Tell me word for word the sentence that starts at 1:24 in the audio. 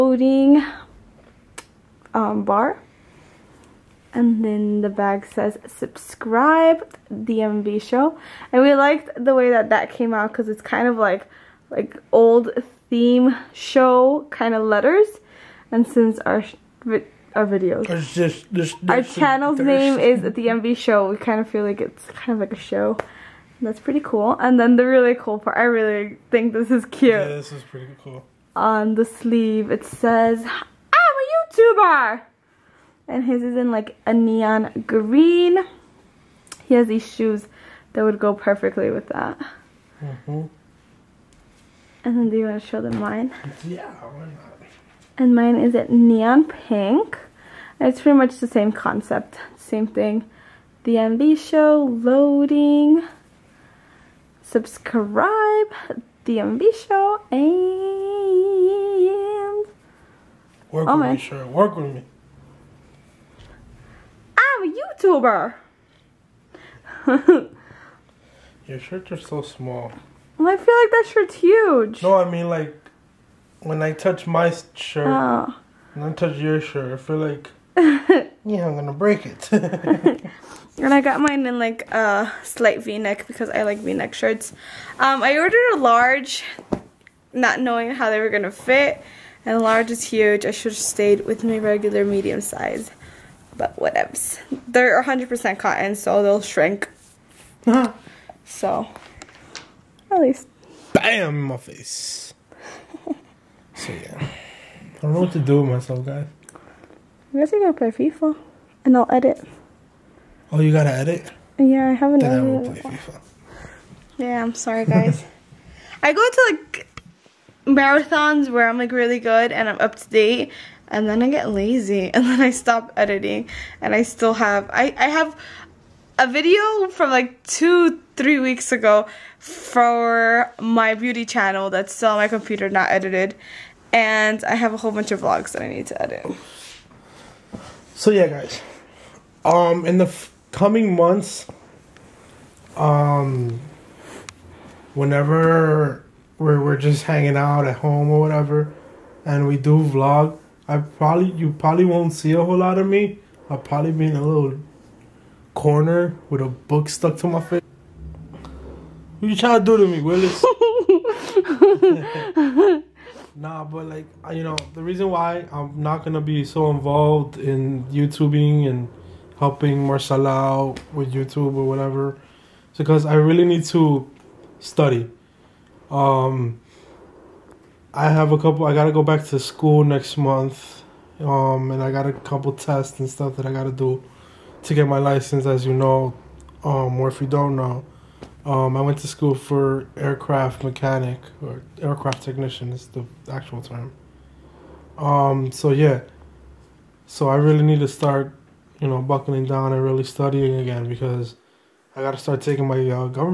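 Um, I ordered a large, not knowing how they were gonna fit, and large is huge.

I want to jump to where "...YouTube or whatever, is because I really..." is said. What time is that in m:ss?
2:51.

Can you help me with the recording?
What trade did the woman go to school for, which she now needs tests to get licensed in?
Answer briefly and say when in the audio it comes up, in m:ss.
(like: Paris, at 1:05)
aircraft technician, at 3:11.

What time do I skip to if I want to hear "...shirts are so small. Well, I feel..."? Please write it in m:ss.
1:08.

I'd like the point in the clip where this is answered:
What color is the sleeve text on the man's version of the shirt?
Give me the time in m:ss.
0:34.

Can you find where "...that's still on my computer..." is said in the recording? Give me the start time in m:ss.
2:11.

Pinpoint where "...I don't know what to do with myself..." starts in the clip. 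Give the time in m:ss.
1:44.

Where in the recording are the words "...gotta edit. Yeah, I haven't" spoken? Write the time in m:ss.
1:50.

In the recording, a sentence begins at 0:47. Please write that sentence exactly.
It's pretty much the same concept, same thing.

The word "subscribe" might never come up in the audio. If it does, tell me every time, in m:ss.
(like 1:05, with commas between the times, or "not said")
0:05, 0:54.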